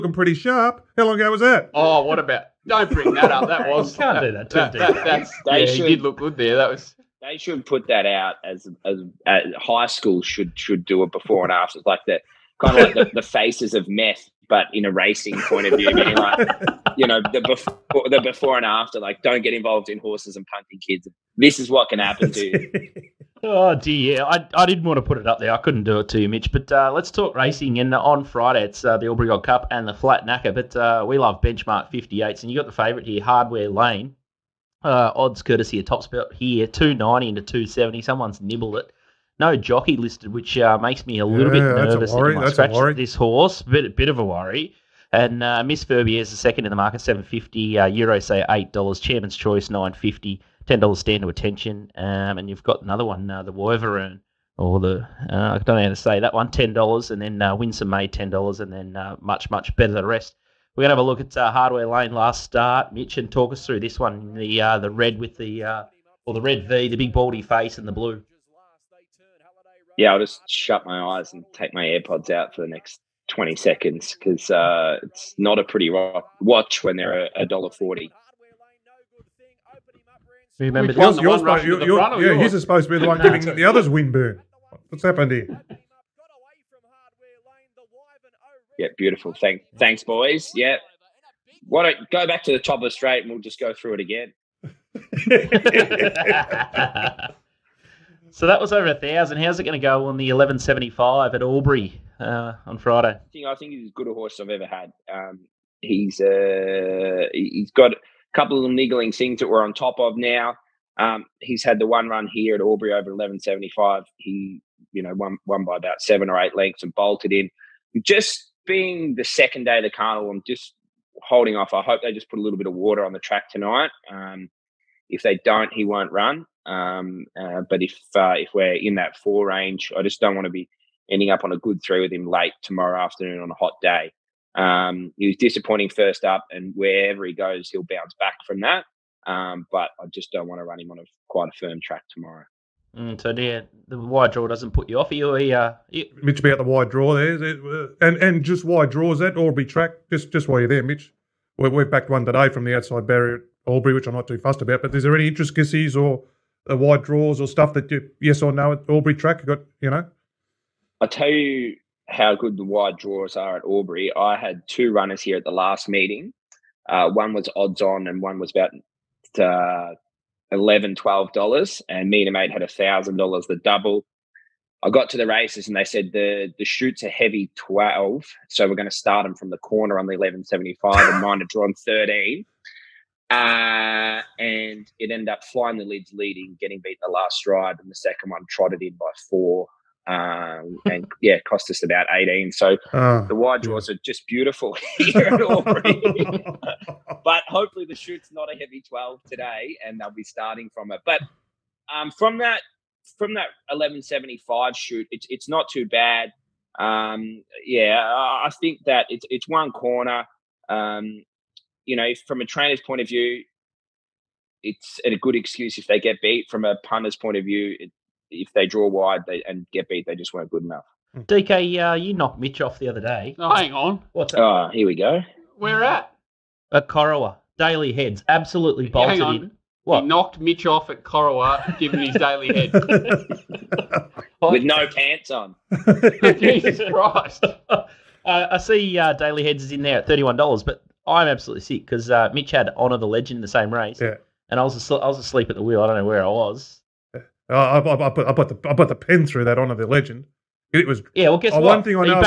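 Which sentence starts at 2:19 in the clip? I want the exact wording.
Um, but I just don't want to run him on a quite a firm track tomorrow.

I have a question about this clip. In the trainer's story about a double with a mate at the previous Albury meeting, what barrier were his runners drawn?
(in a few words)
13.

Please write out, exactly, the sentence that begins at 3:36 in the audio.
From a punter's point of view, it, if they draw wide they, and get beat, they just weren't good enough.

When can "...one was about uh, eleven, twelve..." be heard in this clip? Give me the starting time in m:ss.
2:48.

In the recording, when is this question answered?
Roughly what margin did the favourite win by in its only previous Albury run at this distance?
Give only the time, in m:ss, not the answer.
1:56.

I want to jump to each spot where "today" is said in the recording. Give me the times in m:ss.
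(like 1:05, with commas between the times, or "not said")
2:32, 3:19.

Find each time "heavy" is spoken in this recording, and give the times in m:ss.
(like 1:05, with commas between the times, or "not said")
2:57, 3:18.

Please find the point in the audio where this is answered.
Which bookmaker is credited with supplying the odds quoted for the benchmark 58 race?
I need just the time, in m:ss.
0:35.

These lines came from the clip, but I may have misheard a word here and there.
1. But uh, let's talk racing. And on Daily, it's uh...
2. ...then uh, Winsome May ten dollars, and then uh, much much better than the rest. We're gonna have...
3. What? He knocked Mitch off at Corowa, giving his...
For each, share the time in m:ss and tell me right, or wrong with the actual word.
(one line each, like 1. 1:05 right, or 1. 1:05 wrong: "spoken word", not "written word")
1. 0:26 wrong: "Friday", not "Daily"
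2. 0:57 right
3. 3:49 right.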